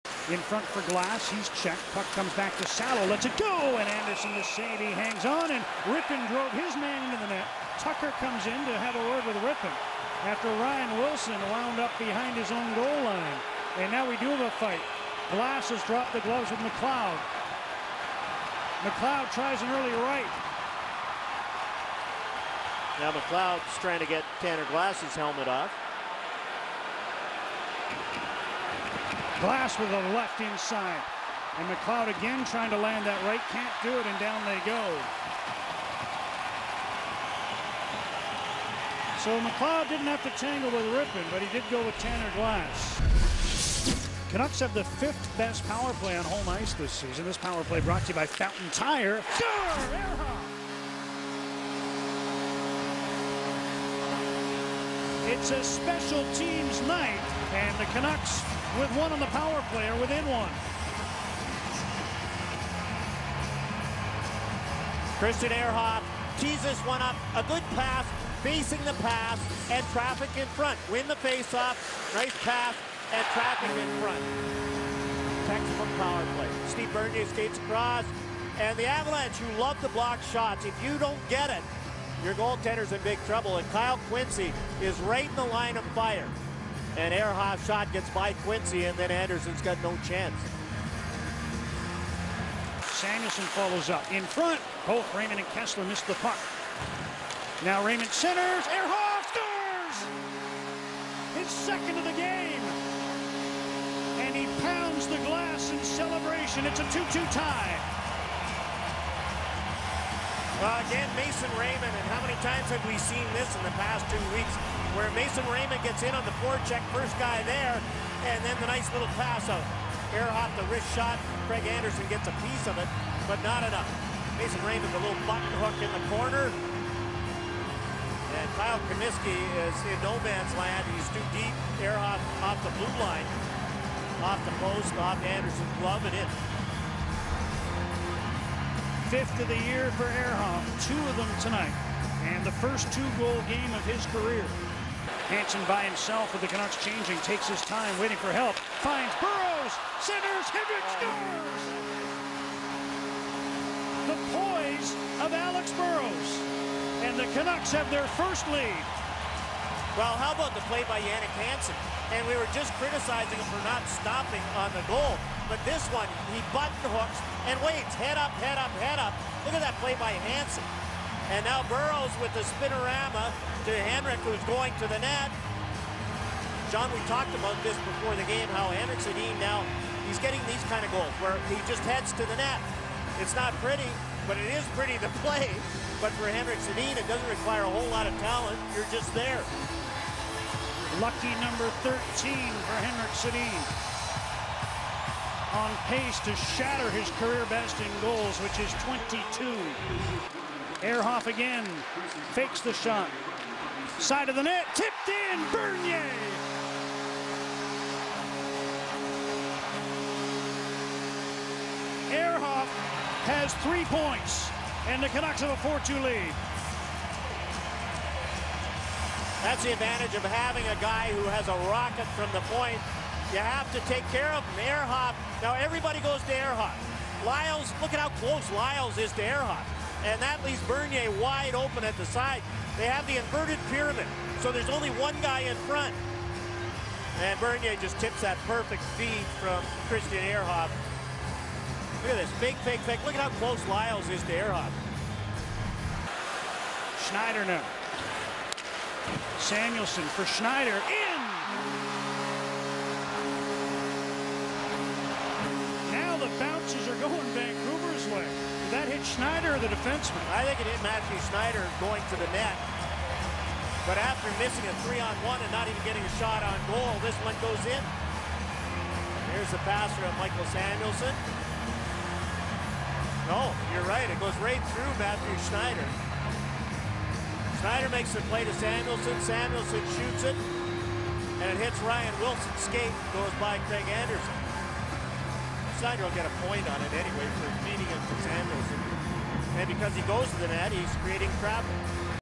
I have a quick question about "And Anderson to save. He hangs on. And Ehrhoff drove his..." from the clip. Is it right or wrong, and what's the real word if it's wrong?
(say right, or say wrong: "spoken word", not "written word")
wrong: "Rypien", not "Ehrhoff".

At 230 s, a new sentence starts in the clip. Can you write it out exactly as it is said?
And that leaves Bernier wide open at the side.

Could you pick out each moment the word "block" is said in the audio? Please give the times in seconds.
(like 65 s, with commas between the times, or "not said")
79 s.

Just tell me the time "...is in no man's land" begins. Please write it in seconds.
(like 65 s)
129 s.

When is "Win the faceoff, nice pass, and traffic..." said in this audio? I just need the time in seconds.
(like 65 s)
70 s.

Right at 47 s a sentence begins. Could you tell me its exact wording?
This power play brought to you by Fountain Tire.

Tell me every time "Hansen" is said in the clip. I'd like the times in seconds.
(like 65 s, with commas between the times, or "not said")
145 s, 161 s, 170 s.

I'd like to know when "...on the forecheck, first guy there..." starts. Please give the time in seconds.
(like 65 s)
116 s.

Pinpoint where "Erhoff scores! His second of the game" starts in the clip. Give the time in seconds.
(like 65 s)
98 s.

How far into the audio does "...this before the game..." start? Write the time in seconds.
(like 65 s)
177 s.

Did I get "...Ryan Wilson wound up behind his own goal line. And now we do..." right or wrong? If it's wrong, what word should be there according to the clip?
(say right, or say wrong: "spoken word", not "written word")
right.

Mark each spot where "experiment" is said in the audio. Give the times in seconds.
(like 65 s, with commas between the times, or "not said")
not said.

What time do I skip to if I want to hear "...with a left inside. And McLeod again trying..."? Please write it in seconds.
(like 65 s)
29 s.